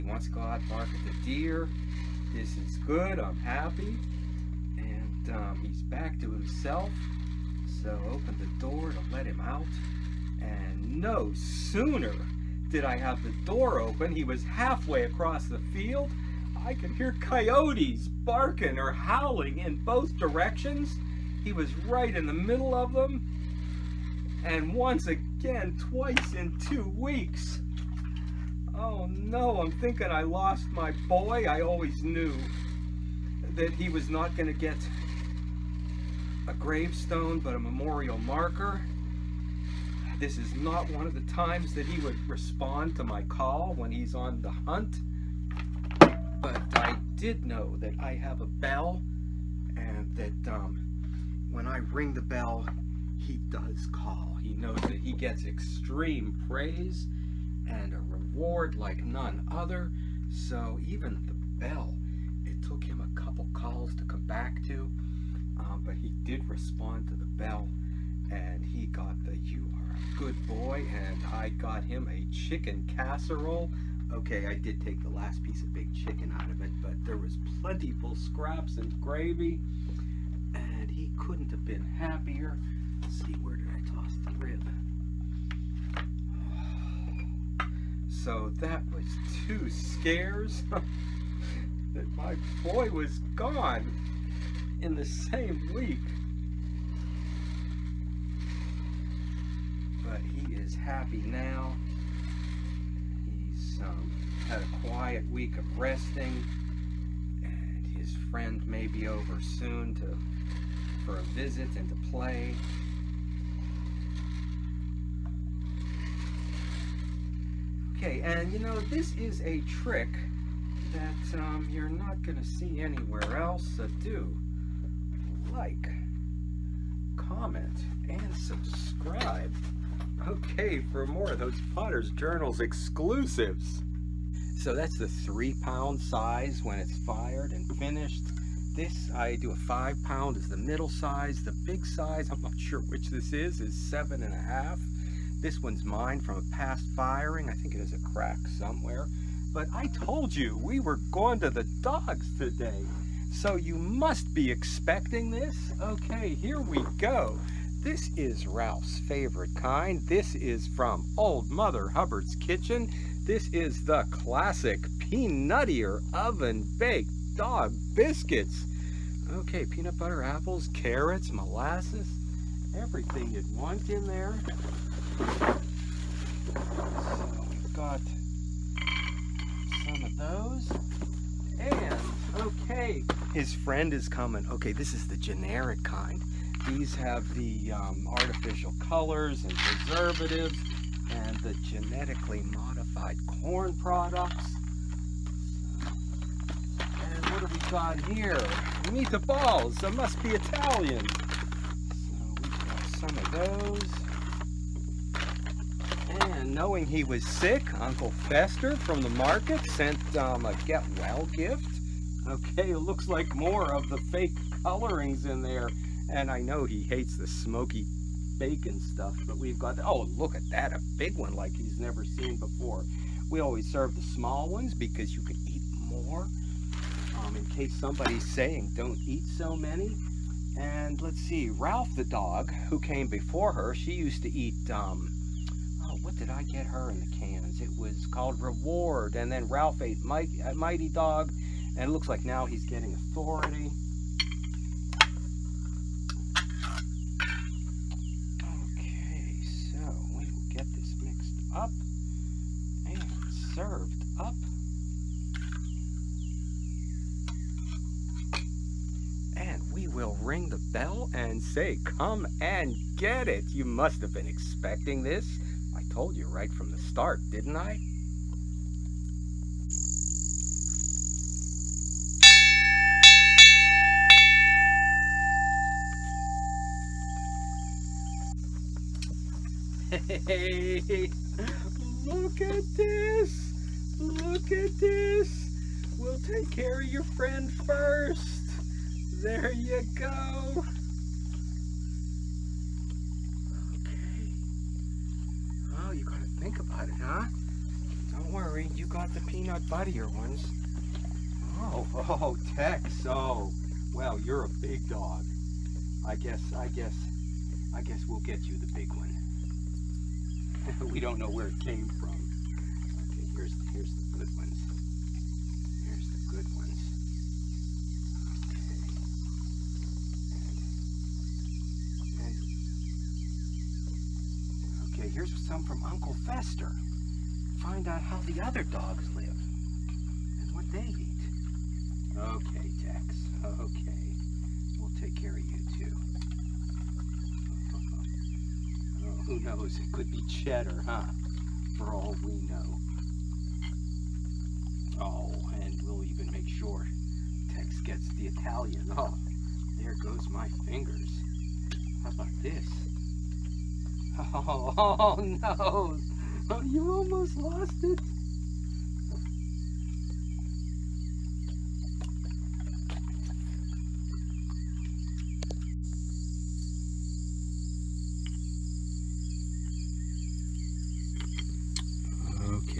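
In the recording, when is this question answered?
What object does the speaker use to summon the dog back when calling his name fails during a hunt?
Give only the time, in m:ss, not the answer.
0:48.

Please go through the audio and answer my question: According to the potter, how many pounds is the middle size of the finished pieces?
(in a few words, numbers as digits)
5 pounds.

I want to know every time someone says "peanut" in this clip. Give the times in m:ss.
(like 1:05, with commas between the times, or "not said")
2:49, 4:59.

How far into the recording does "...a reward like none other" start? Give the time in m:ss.
0:57.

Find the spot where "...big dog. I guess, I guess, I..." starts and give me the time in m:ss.
5:04.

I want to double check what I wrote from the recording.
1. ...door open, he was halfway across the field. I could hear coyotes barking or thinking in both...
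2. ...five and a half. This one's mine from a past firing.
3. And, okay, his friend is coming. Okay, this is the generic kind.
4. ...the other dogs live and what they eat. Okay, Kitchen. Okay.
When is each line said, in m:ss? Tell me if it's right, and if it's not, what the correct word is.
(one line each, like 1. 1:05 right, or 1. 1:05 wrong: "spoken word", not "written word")
1. 0:13 wrong: "howling", not "thinking"
2. 2:23 wrong: "seven", not "five"
3. 3:01 right
4. 5:28 wrong: "Tex", not "Kitchen".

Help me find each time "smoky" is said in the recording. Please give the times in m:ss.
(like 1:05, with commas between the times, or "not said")
3:37.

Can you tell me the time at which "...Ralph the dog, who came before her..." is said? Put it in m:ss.
3:51.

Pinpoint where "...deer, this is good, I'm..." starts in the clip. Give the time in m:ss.
0:01.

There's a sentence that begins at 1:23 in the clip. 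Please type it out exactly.
Let's see, where did I toss the rib?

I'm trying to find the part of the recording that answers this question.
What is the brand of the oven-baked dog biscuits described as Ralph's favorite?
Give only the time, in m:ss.
2:41.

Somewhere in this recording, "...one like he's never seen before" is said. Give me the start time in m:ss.
3:41.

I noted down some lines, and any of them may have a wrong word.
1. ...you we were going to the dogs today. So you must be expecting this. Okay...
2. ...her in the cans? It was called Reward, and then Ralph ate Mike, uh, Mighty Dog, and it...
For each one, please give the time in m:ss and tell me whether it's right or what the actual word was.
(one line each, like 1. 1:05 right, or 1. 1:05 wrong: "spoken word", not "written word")
1. 2:30 right
2. 3:56 right.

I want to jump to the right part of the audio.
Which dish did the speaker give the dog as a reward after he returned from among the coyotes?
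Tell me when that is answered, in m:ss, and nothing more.
1:12.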